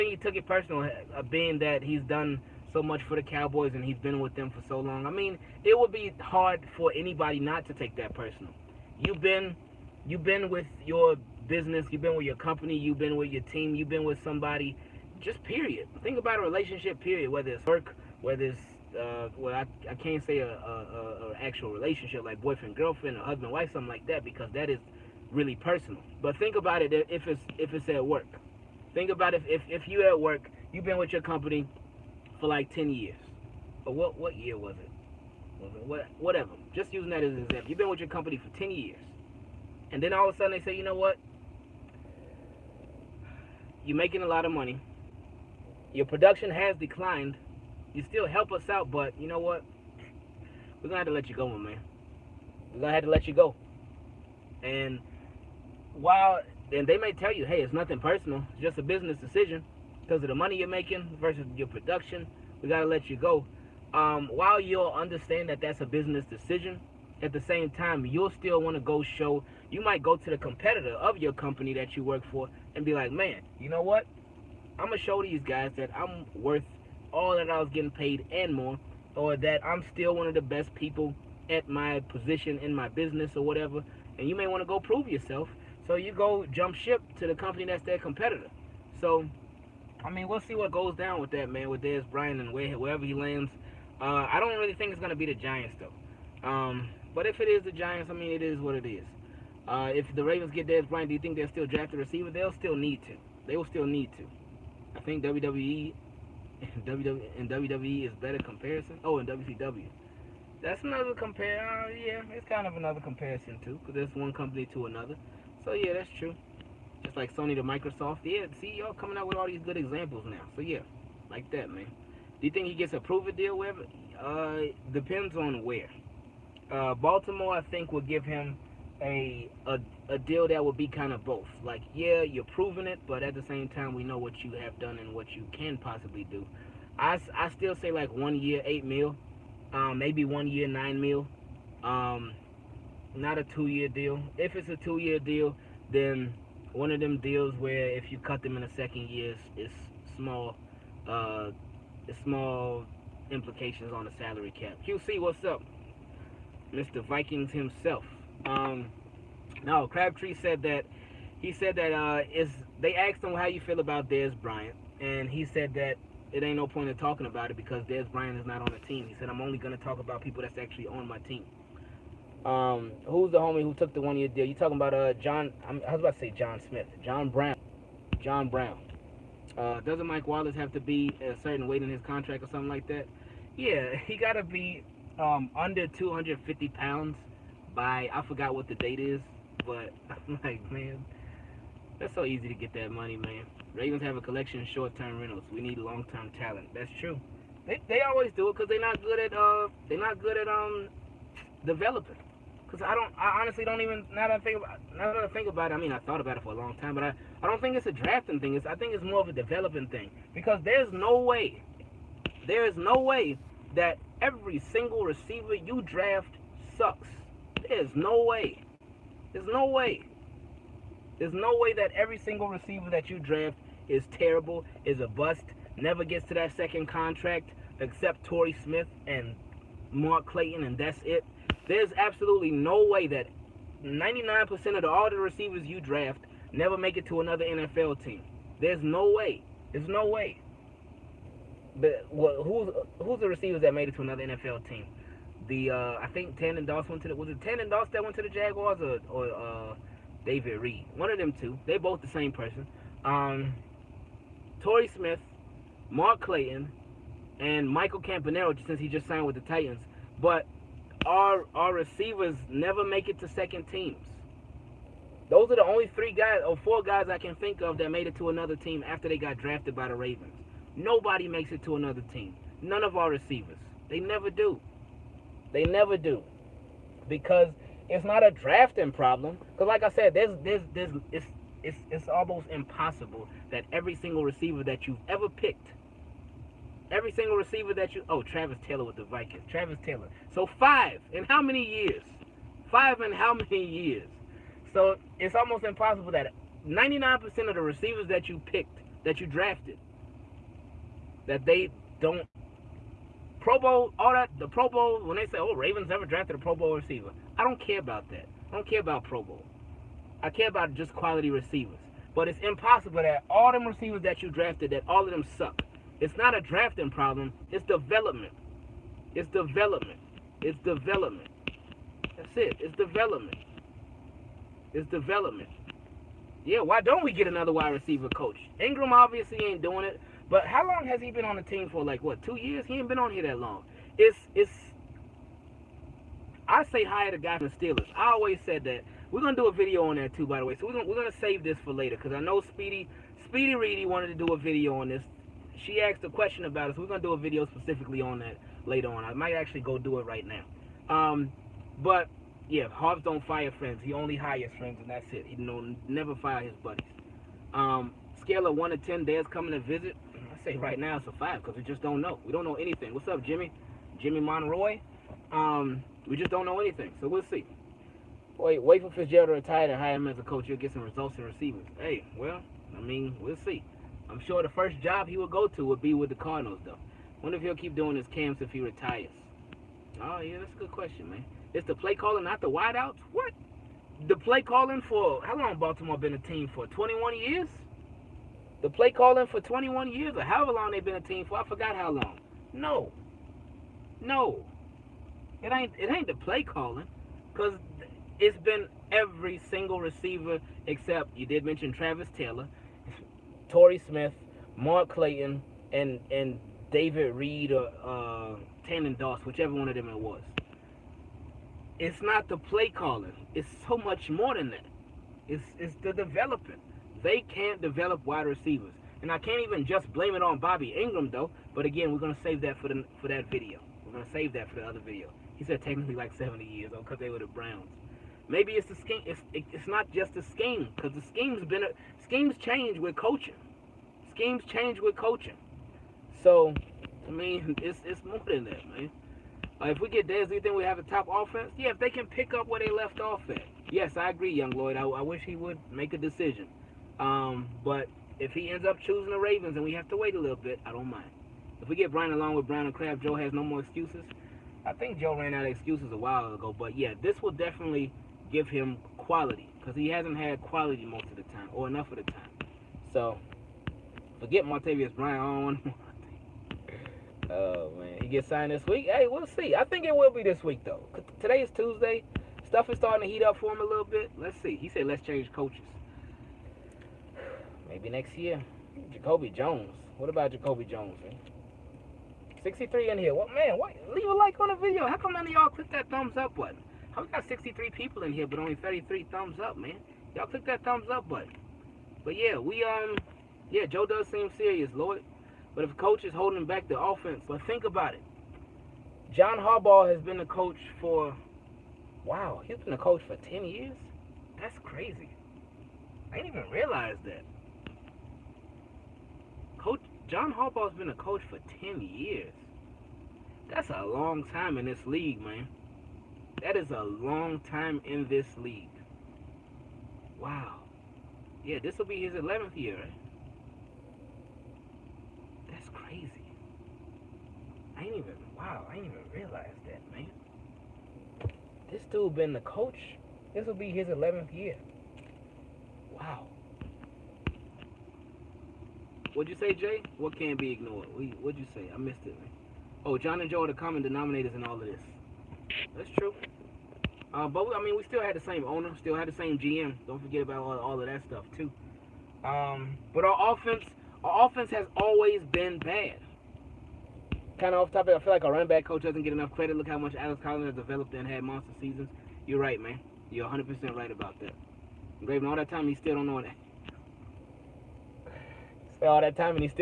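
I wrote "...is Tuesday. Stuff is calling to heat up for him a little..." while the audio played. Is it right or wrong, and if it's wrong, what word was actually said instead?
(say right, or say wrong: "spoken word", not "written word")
wrong: "starting", not "calling".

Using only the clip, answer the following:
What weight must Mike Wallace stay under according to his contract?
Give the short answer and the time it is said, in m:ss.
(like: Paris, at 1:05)
250 pounds, at 3:05.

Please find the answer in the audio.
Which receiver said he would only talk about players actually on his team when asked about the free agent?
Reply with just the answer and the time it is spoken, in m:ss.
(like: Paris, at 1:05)
Crabtree, at 2:39.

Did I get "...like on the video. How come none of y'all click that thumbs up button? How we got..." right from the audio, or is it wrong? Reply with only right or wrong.
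right.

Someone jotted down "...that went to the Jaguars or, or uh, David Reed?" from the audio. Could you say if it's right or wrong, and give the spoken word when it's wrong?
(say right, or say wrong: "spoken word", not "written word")
right.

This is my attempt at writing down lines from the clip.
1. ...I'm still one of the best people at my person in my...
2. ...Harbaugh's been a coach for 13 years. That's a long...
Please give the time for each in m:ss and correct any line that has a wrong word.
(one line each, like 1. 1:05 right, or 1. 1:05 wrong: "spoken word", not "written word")
1. 1:19 wrong: "position", not "person"
2. 8:30 wrong: "10", not "13".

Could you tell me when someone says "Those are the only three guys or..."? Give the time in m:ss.
4:25.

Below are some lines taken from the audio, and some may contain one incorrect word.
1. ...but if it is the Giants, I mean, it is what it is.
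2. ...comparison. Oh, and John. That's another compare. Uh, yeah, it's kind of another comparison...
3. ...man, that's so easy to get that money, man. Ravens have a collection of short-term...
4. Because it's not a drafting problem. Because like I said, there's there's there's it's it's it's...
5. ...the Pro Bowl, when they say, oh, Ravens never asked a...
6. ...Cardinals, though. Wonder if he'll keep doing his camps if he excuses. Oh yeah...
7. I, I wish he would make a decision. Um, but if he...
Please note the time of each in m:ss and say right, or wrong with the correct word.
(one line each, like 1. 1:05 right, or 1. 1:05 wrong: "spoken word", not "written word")
1. 1:37 right
2. 1:48 wrong: "WCW", not "John"
3. 3:10 right
4. 4:37 right
5. 5:04 wrong: "drafted", not "asked"
6. 6:16 wrong: "retires", not "excuses"
7. 7:24 right.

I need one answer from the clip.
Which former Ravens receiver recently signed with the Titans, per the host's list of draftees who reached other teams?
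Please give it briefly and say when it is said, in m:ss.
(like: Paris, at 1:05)
Michael Campanaro, at 4:17.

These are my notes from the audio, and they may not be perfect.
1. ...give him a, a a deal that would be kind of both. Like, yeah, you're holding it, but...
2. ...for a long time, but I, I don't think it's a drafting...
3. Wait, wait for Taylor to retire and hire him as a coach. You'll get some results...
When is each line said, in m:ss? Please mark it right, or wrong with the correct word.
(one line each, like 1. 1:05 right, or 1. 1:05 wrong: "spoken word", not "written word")
1. 2:07 wrong: "proving", not "holding"
2. 3:26 right
3. 6:08 wrong: "Fitzgerald", not "Taylor".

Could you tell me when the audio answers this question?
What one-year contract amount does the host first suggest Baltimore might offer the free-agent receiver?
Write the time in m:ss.
2:18.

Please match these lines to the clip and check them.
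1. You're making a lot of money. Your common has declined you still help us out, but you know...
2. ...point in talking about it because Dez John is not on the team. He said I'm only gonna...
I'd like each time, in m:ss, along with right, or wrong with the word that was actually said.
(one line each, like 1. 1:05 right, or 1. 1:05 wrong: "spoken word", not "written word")
1. 0:43 wrong: "production", not "common"
2. 2:46 wrong: "Bryant", not "John".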